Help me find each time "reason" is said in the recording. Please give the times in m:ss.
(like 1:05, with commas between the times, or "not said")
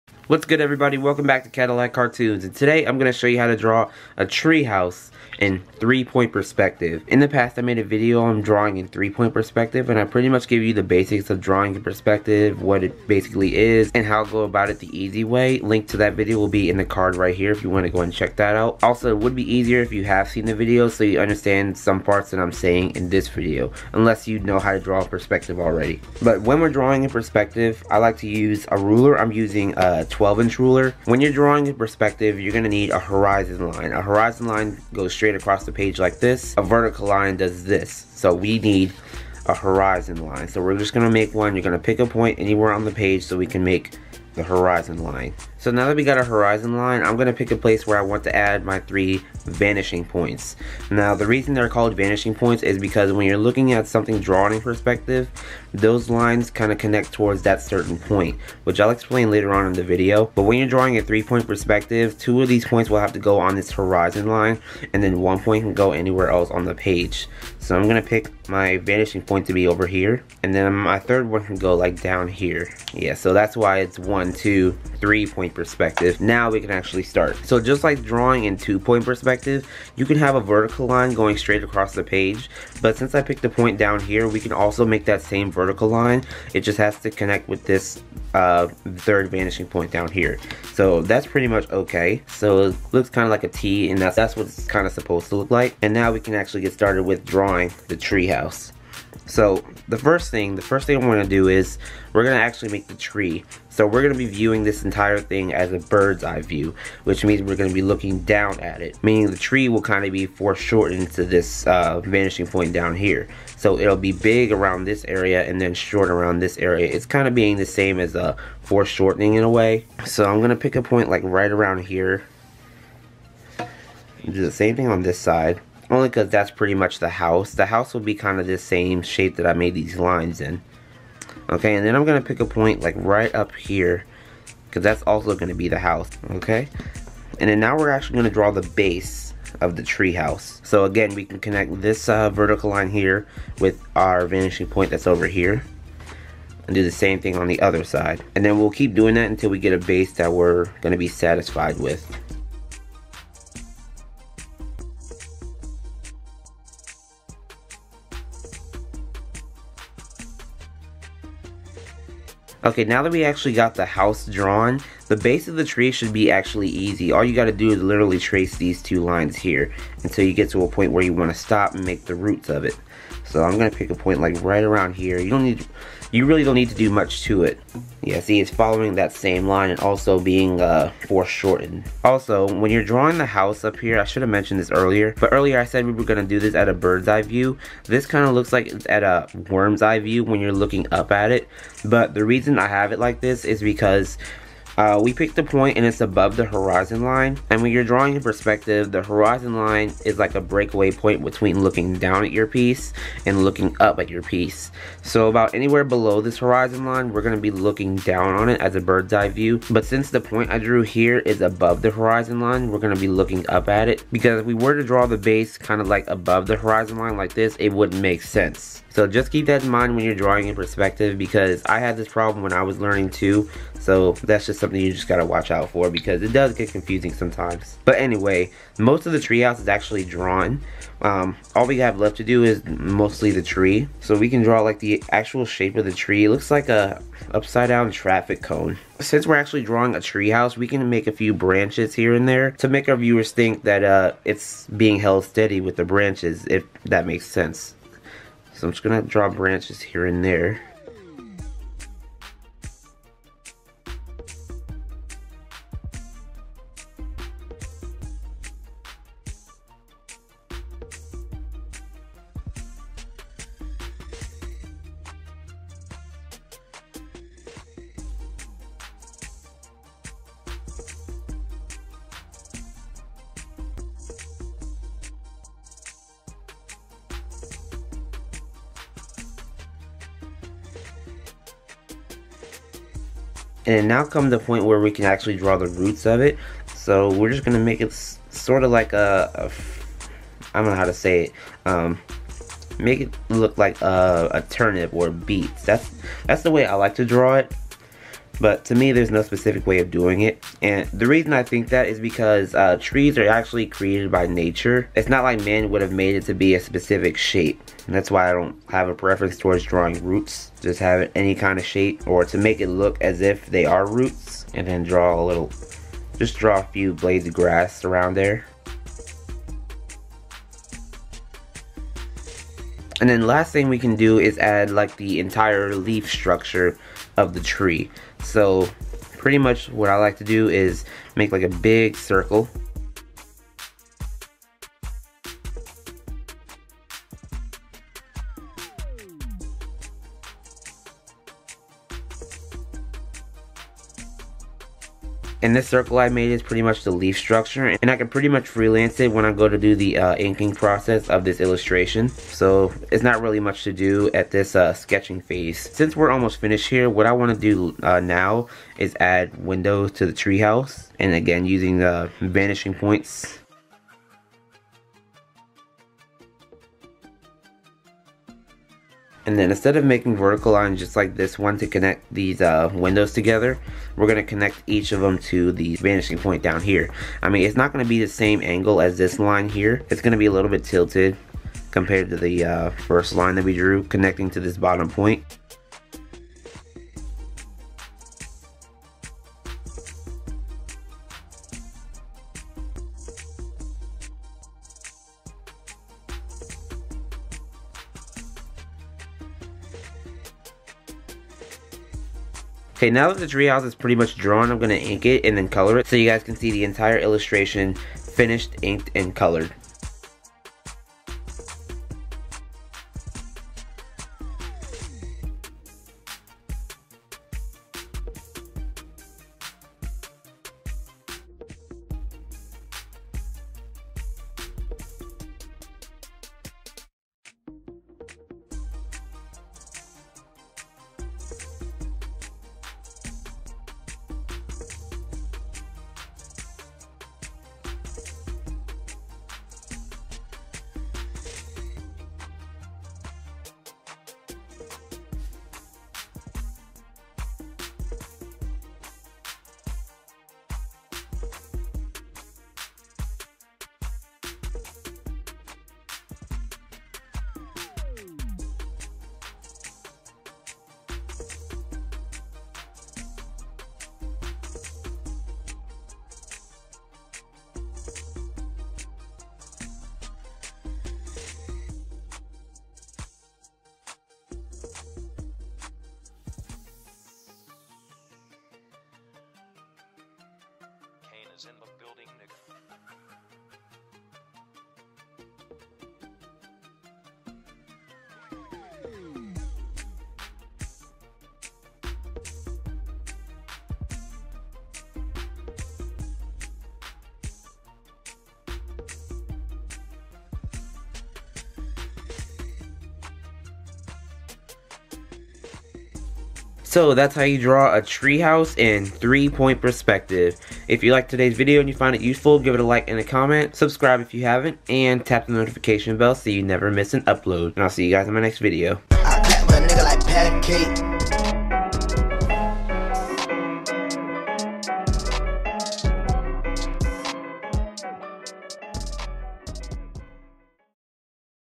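0:51, 3:12, 5:01.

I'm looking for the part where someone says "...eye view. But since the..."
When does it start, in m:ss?
3:29.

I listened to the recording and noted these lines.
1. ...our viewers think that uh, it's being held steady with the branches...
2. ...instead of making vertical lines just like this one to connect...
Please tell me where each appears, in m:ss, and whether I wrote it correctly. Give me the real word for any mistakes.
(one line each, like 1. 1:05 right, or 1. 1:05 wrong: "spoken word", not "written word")
1. 4:02 right
2. 6:09 right.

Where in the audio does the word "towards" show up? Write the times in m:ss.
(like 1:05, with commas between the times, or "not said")
0:57, 5:09.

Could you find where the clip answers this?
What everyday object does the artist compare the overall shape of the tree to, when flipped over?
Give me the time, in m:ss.
3:57.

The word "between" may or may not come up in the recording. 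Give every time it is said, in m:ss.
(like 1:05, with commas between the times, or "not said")
3:21.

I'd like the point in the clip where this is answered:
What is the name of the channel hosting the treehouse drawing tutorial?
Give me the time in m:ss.
0:01.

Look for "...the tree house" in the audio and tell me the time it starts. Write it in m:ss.
2:19.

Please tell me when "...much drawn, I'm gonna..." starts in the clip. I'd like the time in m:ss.
6:43.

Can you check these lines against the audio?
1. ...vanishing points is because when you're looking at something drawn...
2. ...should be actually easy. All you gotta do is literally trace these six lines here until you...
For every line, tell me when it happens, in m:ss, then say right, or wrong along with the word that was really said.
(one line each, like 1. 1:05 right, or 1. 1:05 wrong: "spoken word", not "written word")
1. 0:51 right
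2. 2:45 wrong: "two", not "six".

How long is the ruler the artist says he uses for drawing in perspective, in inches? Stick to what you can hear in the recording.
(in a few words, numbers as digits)
12.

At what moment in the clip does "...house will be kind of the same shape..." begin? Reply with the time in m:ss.
2:07.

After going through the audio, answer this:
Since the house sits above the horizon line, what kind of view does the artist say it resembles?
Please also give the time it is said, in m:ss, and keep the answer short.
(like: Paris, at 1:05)
worm's eye view, at 3:09.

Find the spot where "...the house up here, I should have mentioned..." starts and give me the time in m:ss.
3:03.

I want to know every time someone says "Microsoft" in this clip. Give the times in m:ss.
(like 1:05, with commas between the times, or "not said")
not said.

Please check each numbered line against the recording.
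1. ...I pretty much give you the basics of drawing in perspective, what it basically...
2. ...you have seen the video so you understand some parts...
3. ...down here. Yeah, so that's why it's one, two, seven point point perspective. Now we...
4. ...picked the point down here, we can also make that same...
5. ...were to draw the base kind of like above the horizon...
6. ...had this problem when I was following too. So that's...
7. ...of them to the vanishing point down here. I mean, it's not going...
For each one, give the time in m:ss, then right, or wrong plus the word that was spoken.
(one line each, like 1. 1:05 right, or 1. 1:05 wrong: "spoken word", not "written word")
1. 0:09 right
2. 0:19 right
3. 1:12 wrong: "three", not "seven"
4. 1:23 right
5. 3:34 right
6. 3:41 wrong: "learning", not "following"
7. 6:14 right.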